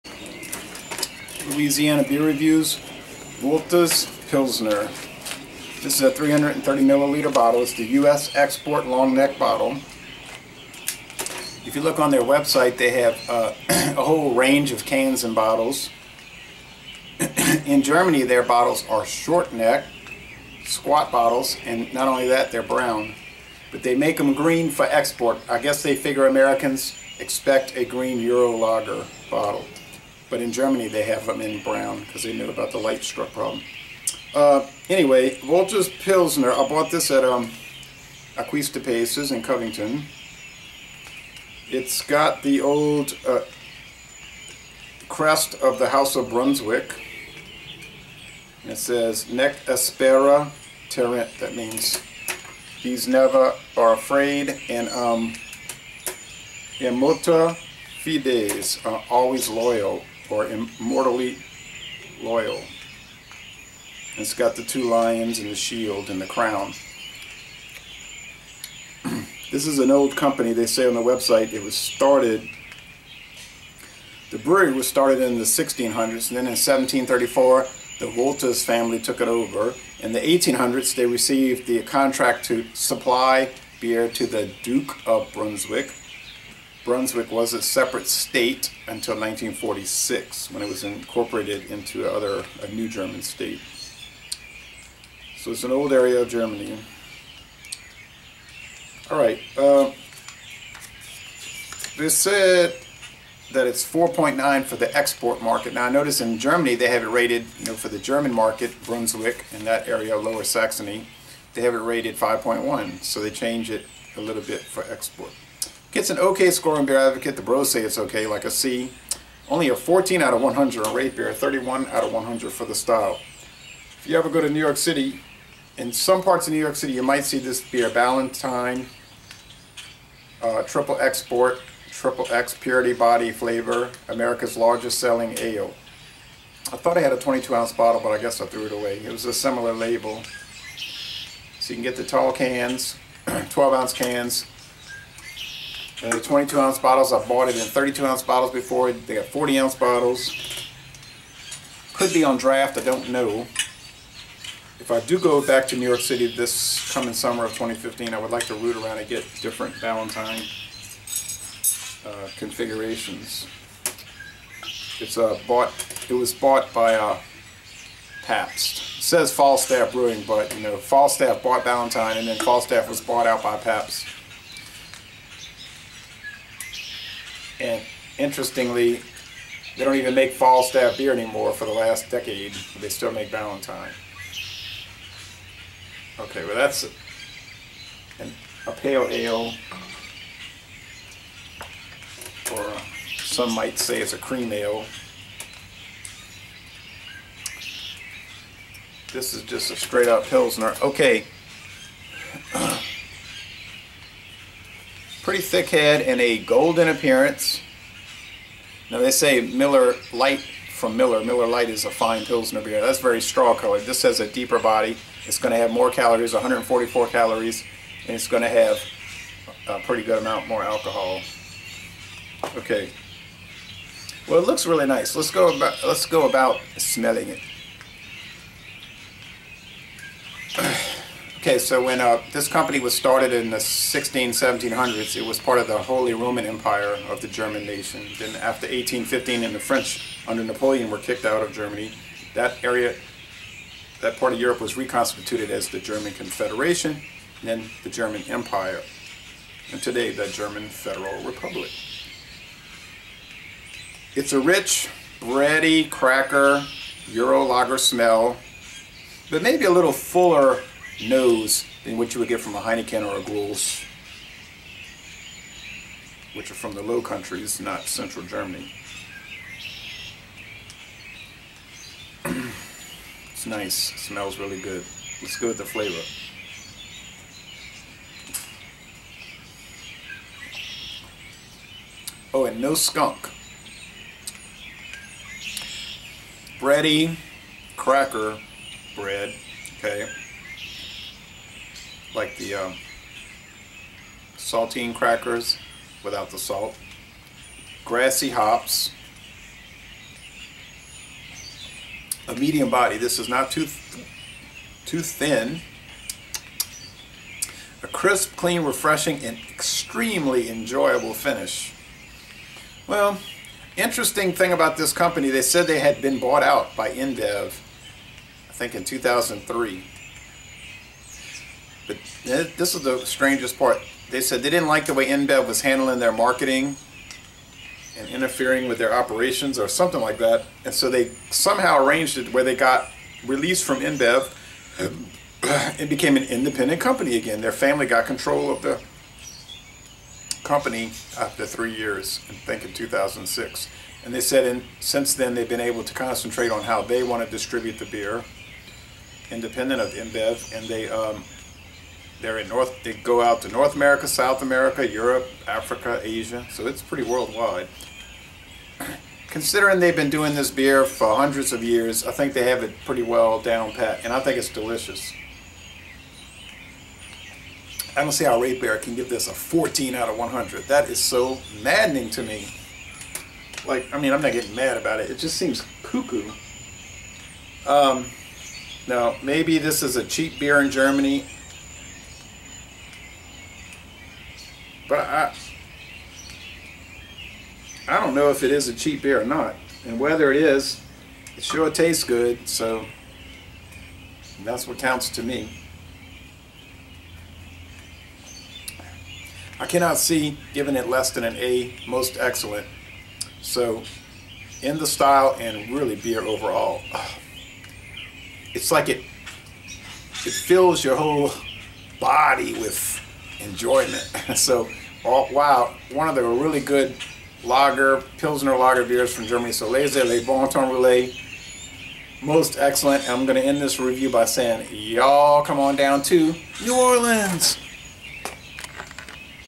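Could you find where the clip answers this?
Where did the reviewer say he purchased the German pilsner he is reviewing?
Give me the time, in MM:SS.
00:38.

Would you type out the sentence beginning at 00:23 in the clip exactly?
But they make them green for export.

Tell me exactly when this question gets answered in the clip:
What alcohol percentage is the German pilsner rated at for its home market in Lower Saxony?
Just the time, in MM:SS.
01:52.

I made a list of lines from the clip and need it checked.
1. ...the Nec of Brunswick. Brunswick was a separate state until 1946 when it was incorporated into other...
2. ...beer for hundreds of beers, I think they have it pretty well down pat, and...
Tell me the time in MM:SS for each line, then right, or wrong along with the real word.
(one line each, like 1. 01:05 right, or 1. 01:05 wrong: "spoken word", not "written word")
1. 01:24 wrong: "Duke", not "Nec"
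2. 06:00 wrong: "years", not "beers".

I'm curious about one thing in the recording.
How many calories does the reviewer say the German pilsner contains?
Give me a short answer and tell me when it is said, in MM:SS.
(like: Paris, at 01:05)
144, at 03:36.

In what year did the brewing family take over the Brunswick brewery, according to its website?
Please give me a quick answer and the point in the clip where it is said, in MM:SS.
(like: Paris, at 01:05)
1734, at 01:16.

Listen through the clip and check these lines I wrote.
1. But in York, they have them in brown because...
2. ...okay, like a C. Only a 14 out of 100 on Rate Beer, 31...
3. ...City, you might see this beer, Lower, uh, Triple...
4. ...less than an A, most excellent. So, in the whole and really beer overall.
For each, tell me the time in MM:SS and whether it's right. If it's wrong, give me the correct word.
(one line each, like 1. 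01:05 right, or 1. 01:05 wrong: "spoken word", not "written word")
1. 00:30 wrong: "Germany", not "York"
2. 01:57 right
3. 02:06 wrong: "Ballantine", not "Lower"
4. 06:40 wrong: "style", not "whole".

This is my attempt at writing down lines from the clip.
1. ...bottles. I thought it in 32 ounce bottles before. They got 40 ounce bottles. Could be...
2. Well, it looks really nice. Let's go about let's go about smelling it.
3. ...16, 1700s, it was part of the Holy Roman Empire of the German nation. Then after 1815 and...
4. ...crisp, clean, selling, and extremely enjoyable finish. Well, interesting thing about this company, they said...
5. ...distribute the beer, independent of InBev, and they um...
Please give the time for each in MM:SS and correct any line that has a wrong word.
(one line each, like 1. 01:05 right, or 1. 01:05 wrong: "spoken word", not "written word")
1. 02:26 wrong: "bought", not "thought"
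2. 03:44 right
3. 03:53 right
4. 05:07 wrong: "refreshing", not "selling"
5. 05:47 right.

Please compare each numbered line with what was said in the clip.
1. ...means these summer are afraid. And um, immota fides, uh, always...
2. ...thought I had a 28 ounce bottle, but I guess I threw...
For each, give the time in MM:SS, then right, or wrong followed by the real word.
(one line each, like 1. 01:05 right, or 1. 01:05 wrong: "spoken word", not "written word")
1. 00:51 wrong: "never", not "summer"
2. 02:16 wrong: "22", not "28".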